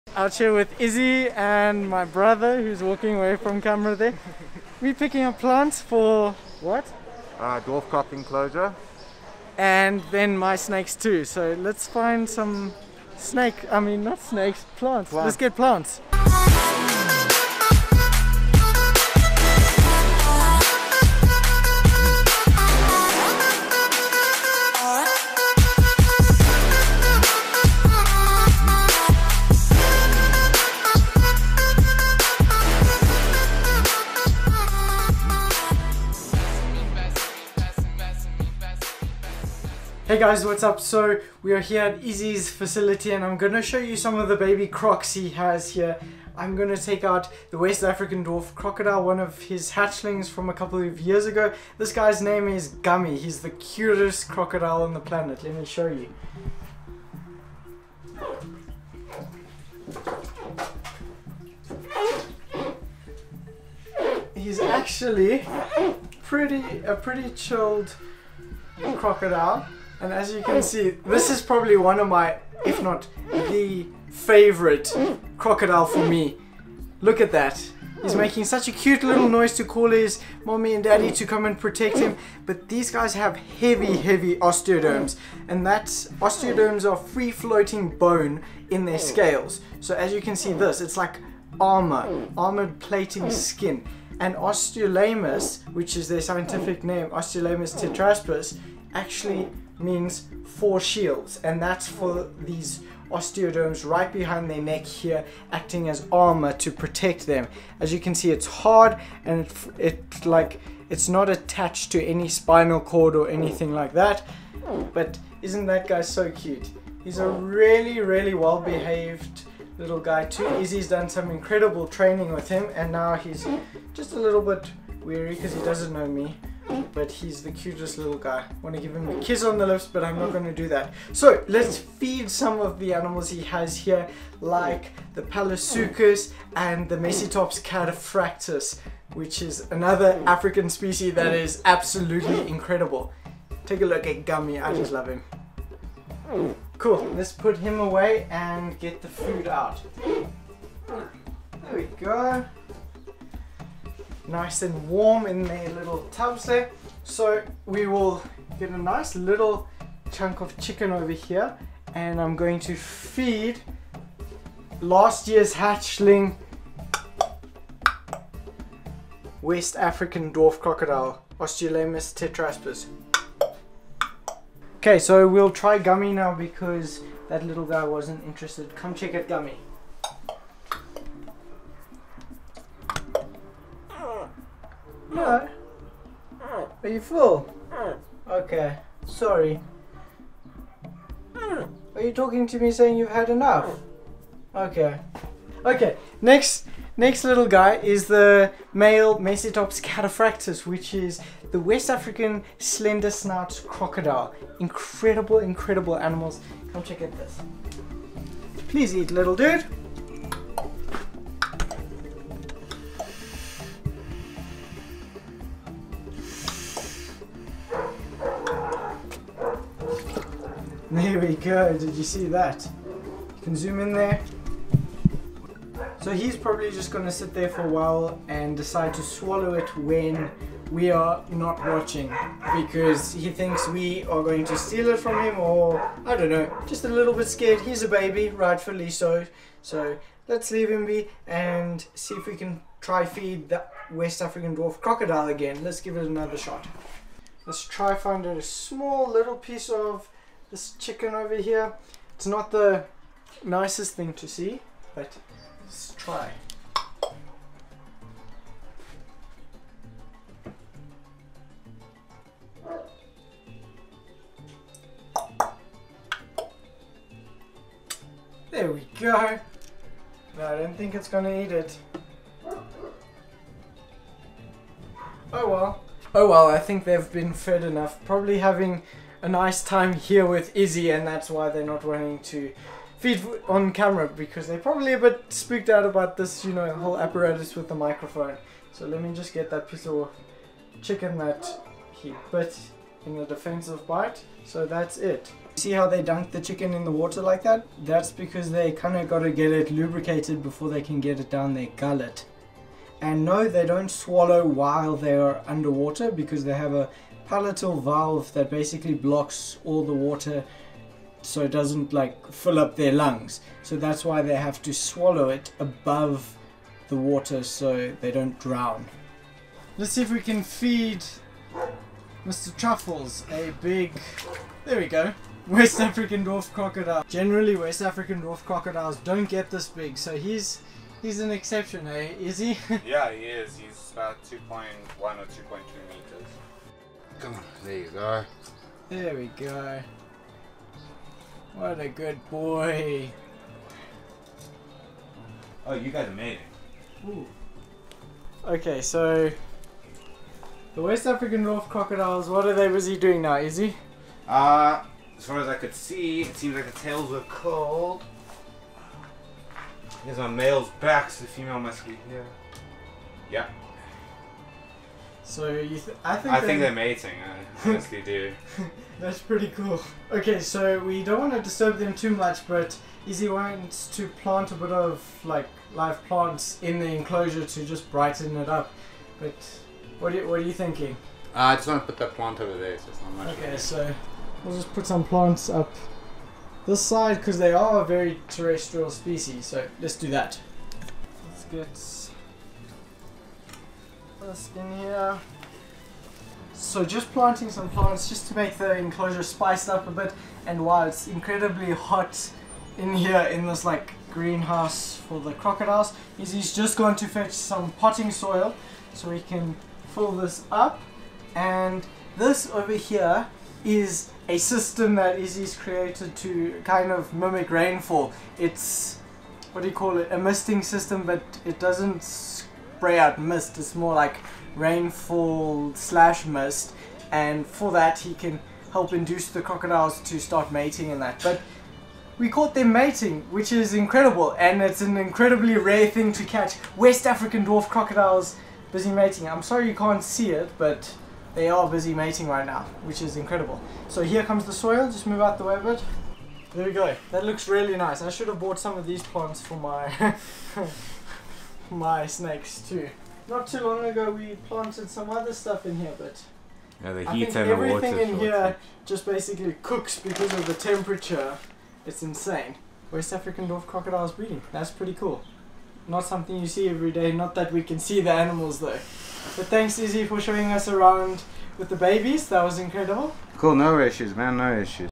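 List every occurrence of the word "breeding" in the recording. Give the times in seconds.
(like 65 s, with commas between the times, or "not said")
464 s.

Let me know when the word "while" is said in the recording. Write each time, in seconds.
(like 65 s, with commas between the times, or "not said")
227 s, 304 s, 400 s.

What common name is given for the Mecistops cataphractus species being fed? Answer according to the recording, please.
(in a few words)
West African slender snout crocodile.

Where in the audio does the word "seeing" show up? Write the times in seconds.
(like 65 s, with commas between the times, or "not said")
not said.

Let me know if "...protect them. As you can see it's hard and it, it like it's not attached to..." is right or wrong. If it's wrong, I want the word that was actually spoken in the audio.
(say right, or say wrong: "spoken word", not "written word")
right.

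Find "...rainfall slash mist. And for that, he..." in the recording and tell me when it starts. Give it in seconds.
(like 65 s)
424 s.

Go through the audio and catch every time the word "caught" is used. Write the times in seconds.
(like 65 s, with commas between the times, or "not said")
432 s.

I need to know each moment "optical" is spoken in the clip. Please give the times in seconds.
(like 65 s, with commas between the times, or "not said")
not said.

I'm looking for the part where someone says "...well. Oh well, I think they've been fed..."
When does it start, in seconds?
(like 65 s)
275 s.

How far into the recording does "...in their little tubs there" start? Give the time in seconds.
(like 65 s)
155 s.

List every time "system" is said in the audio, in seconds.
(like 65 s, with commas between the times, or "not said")
414 s, 420 s.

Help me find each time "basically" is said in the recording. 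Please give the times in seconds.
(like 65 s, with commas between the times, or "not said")
308 s, 459 s.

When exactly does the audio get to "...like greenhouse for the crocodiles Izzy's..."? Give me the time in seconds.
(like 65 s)
403 s.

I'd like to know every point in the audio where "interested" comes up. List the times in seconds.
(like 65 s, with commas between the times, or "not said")
178 s.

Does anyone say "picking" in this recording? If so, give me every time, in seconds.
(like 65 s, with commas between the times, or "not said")
4 s.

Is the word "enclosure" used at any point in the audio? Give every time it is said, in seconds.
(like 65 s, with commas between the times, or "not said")
8 s, 376 s, 398 s.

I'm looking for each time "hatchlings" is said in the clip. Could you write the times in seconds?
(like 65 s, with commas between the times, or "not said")
49 s, 165 s.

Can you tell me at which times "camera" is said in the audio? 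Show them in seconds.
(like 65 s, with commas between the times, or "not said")
3 s, 283 s.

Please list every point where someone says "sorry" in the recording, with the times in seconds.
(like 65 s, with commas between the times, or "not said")
189 s, 439 s.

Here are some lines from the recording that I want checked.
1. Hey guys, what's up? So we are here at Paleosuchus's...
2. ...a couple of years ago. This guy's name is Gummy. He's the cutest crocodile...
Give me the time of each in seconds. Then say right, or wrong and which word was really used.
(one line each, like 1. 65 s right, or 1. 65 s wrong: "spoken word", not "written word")
1. 40 s wrong: "Izzy", not "Paleosuchus"
2. 50 s right.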